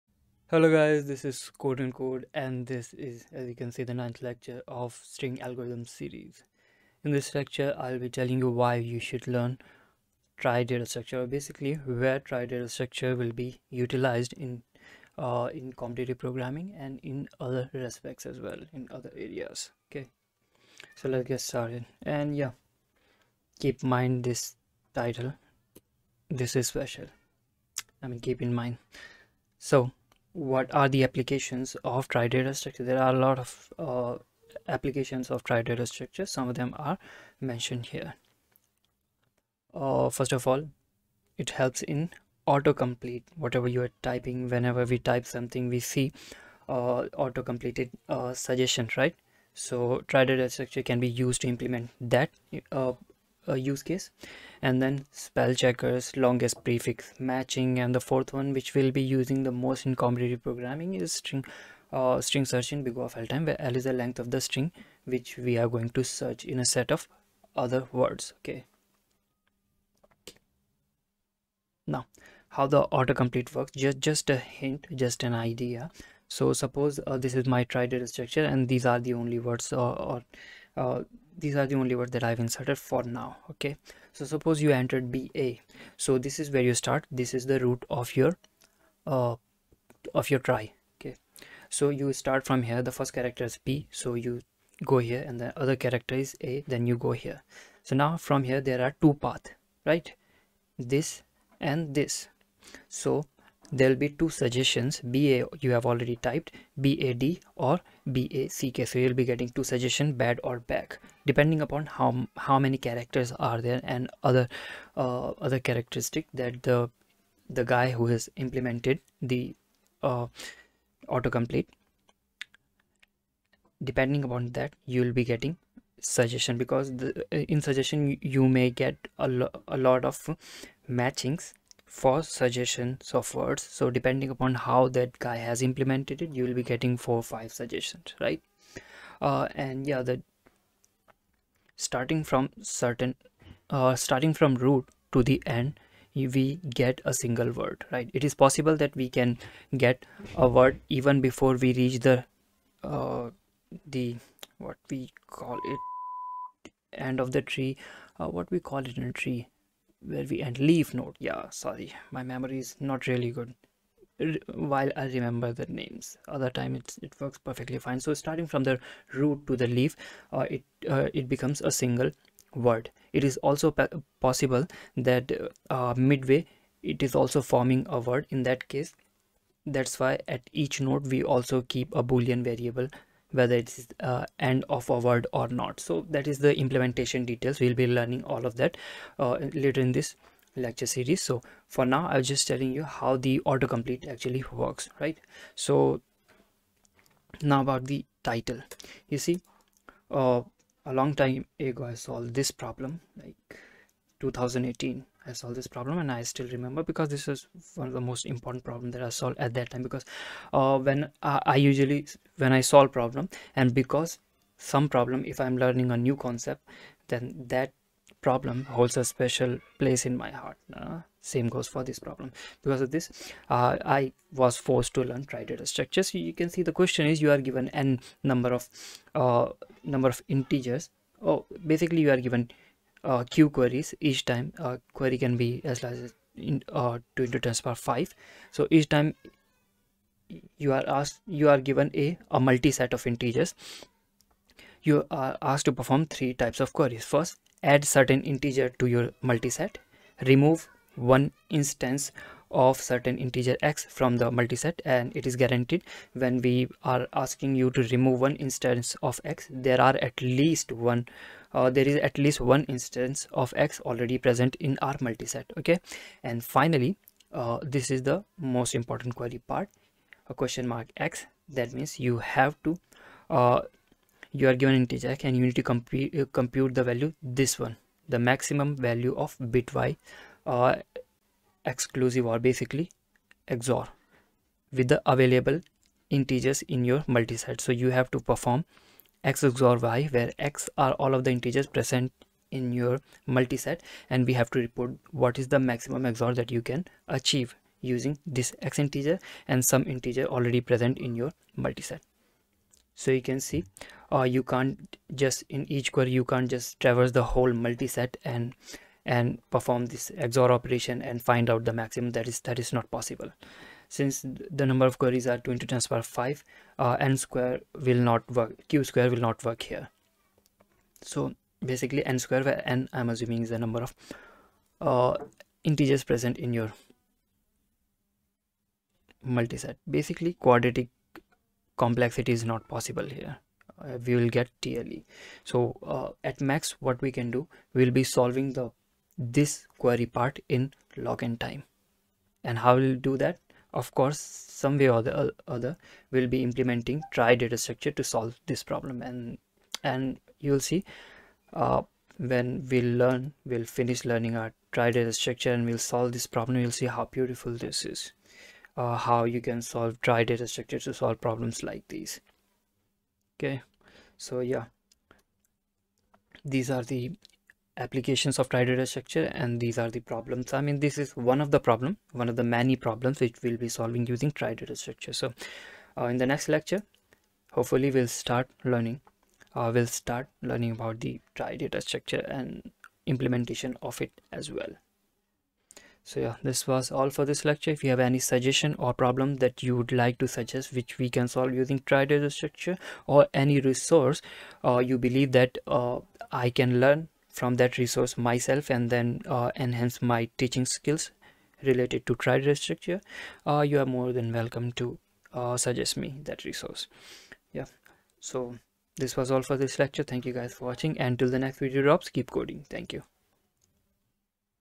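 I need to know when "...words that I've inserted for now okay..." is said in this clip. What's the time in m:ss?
1:21.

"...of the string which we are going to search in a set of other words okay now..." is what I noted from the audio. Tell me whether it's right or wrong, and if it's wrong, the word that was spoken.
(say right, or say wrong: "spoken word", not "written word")
right.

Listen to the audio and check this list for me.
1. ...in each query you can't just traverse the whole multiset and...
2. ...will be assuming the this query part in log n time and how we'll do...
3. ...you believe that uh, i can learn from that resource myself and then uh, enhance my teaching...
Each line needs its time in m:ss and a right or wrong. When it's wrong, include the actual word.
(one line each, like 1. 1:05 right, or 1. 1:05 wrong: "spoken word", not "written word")
1. 5:05 right
2. 5:37 wrong: "solving", not "assuming"
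3. 6:34 right.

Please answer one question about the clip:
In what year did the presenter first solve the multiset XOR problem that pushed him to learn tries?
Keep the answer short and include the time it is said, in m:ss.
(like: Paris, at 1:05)
2018, at 3:24.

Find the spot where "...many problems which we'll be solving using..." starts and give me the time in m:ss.
6:12.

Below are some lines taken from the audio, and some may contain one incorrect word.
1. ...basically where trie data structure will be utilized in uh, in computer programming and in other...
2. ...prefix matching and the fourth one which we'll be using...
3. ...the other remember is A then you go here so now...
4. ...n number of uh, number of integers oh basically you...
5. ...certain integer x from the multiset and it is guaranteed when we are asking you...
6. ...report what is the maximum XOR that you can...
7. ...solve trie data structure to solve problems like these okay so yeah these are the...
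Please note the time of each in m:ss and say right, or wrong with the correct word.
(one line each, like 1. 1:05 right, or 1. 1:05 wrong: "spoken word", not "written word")
1. 0:11 right
2. 0:56 right
3. 1:35 wrong: "character", not "remember"
4. 3:47 right
5. 4:12 right
6. 4:54 right
7. 5:59 right.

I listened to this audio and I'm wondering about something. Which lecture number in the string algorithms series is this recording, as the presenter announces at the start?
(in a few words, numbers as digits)
9th.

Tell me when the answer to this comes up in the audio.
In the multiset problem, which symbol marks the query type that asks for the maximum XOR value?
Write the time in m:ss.
4:30.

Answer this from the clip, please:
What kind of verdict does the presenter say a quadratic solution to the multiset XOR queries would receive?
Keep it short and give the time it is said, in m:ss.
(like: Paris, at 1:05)
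TLE, at 5:34.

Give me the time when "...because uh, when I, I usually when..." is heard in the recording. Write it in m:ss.
3:29.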